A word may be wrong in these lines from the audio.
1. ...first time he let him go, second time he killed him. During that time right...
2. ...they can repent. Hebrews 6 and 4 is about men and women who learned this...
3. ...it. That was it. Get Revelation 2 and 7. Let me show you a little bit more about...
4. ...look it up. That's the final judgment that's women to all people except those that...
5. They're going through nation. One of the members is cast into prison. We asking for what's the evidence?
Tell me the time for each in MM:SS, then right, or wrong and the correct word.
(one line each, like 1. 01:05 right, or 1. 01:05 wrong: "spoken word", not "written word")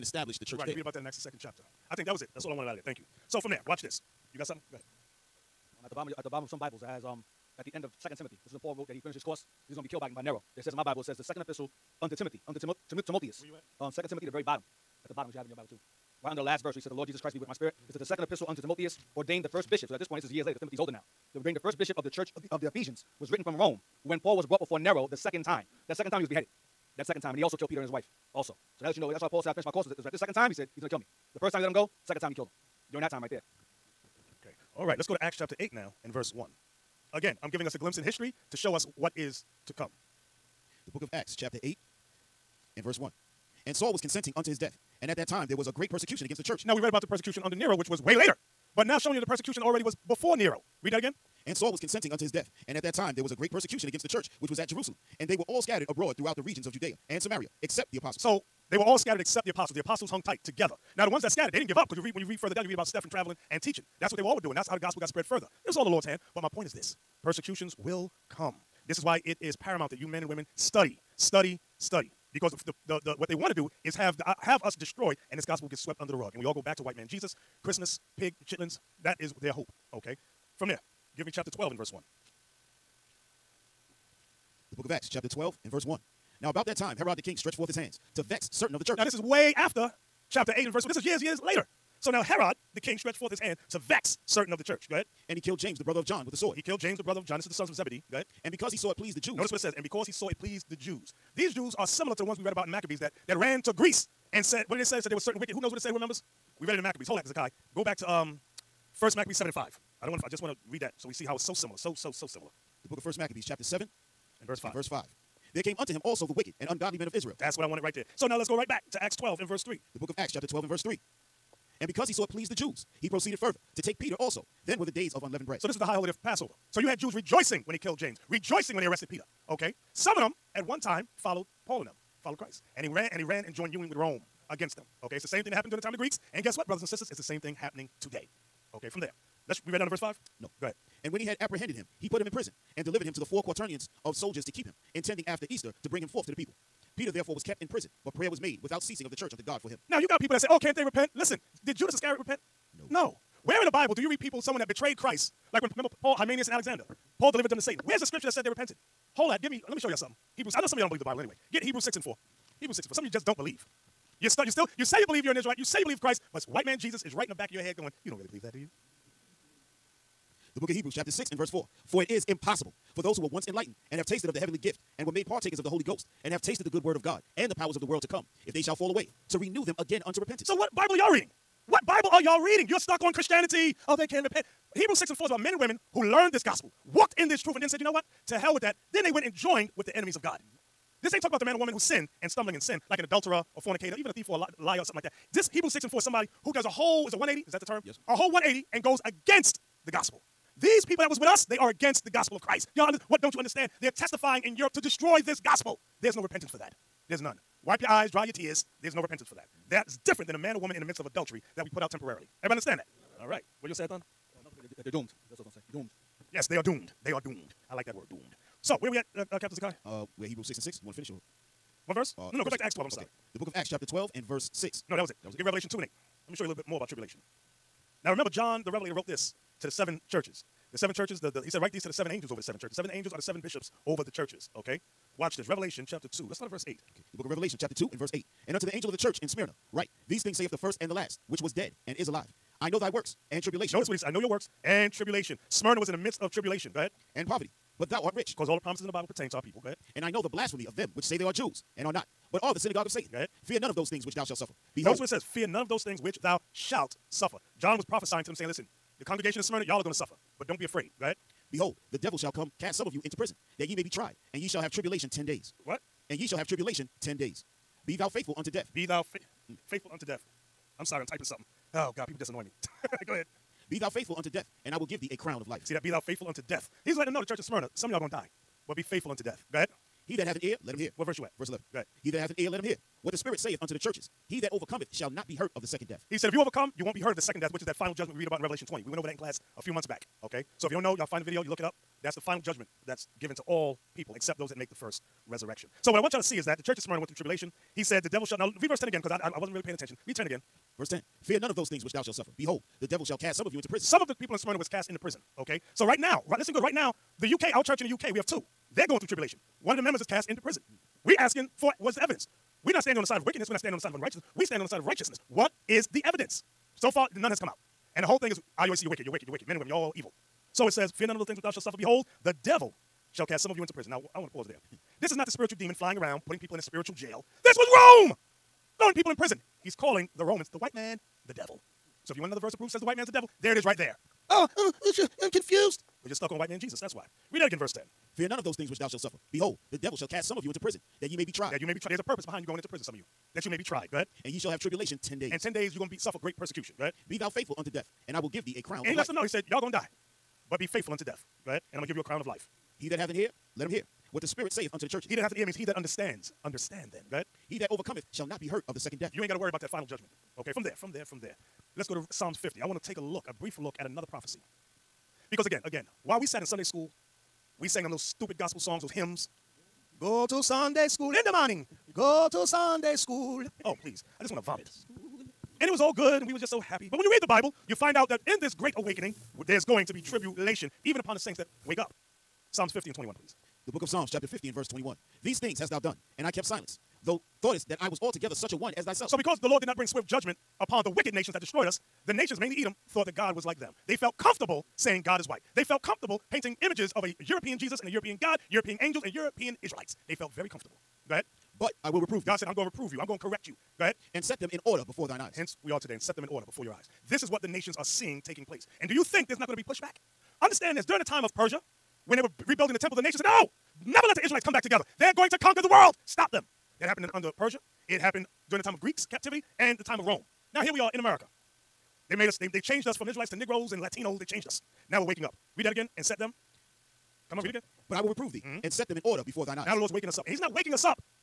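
1. 00:31 right
2. 03:03 right
3. 03:45 wrong: "8", not "7"
4. 04:51 wrong: "given", not "women"
5. 05:08 wrong: "tribulation", not "nation".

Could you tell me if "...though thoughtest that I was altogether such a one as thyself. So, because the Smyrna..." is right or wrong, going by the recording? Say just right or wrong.
wrong.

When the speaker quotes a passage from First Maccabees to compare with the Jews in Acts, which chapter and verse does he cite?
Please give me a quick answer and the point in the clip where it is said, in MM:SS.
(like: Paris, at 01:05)
7:5, at 01:49.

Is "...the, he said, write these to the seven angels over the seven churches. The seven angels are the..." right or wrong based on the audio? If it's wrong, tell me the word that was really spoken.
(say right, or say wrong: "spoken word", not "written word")
right.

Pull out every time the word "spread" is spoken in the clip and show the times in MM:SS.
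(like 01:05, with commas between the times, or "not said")
01:05.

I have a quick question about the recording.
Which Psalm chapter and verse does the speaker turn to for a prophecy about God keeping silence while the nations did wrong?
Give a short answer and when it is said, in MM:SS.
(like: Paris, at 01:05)
Psalms 50:21, at 06:22.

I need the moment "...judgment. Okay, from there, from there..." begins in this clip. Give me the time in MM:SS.
05:59.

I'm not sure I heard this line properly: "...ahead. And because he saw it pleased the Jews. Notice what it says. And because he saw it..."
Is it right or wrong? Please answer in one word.
right.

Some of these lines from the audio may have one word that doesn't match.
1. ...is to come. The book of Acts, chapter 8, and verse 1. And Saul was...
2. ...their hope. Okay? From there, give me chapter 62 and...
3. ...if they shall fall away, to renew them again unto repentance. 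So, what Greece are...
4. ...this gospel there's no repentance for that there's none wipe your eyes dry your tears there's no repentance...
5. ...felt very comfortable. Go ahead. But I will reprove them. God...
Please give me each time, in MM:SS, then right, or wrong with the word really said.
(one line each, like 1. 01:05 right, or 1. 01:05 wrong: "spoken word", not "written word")
1. 00:39 right
2. 01:19 wrong: "12", not "62"
3. 02:58 wrong: "Bible", not "Greece"
4. 03:25 right
5. 06:40 right.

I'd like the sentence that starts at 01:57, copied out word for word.
That's what I wanted right there.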